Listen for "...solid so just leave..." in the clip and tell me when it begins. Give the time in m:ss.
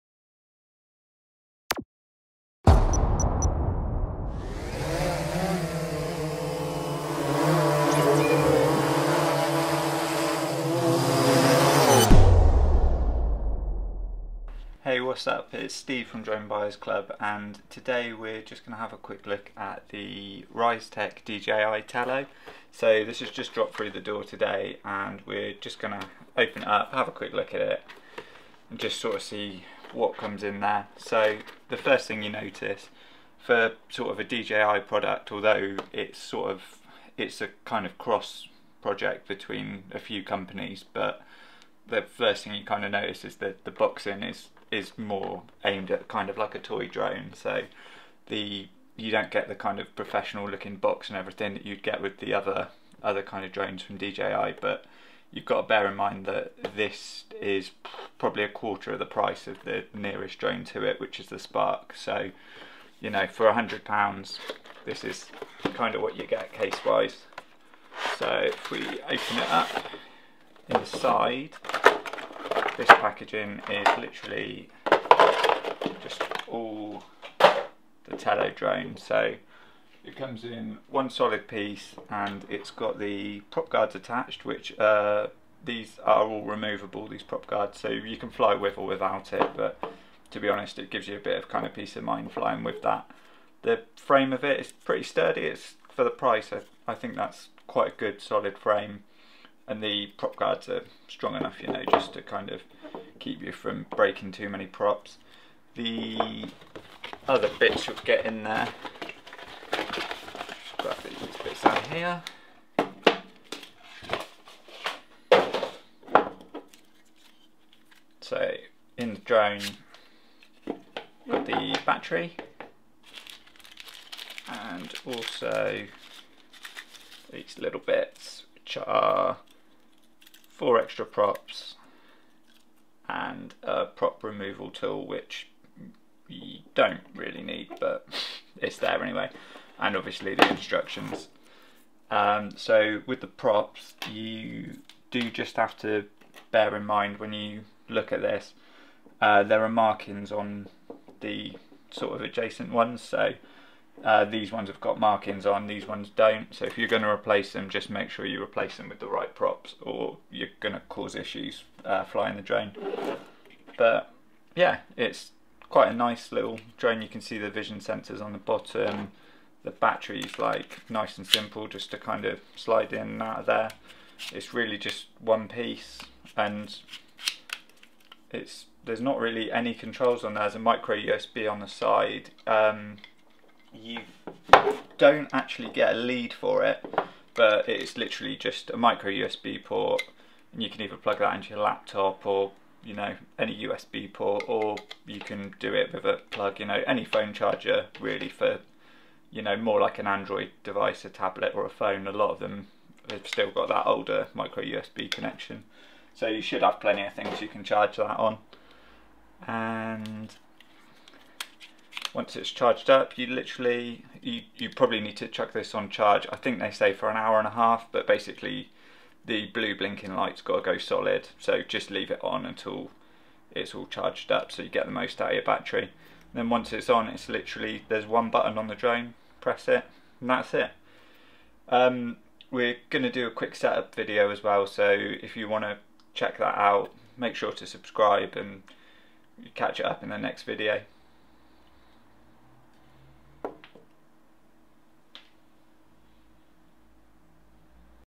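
3:40.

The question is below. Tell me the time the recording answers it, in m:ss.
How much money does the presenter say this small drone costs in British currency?
1:03.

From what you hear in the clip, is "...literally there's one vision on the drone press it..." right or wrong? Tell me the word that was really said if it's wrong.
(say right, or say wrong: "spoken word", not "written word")
wrong: "button", not "vision".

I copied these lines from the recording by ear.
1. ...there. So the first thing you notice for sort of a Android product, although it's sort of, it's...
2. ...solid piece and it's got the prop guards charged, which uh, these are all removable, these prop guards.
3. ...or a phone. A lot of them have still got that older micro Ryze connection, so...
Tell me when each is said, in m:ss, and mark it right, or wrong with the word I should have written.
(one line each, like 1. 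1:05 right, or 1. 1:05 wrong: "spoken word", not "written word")
1. 0:30 wrong: "DJI", not "Android"
2. 1:21 wrong: "attached", not "charged"
3. 3:21 wrong: "USB", not "Ryze".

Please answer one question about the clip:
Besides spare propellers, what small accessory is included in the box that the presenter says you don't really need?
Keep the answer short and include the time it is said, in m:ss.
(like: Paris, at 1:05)
prop removal tool, at 2:13.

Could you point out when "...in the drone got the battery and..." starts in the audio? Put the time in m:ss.
1:58.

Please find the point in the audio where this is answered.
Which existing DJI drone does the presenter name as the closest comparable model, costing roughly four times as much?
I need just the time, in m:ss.
1:01.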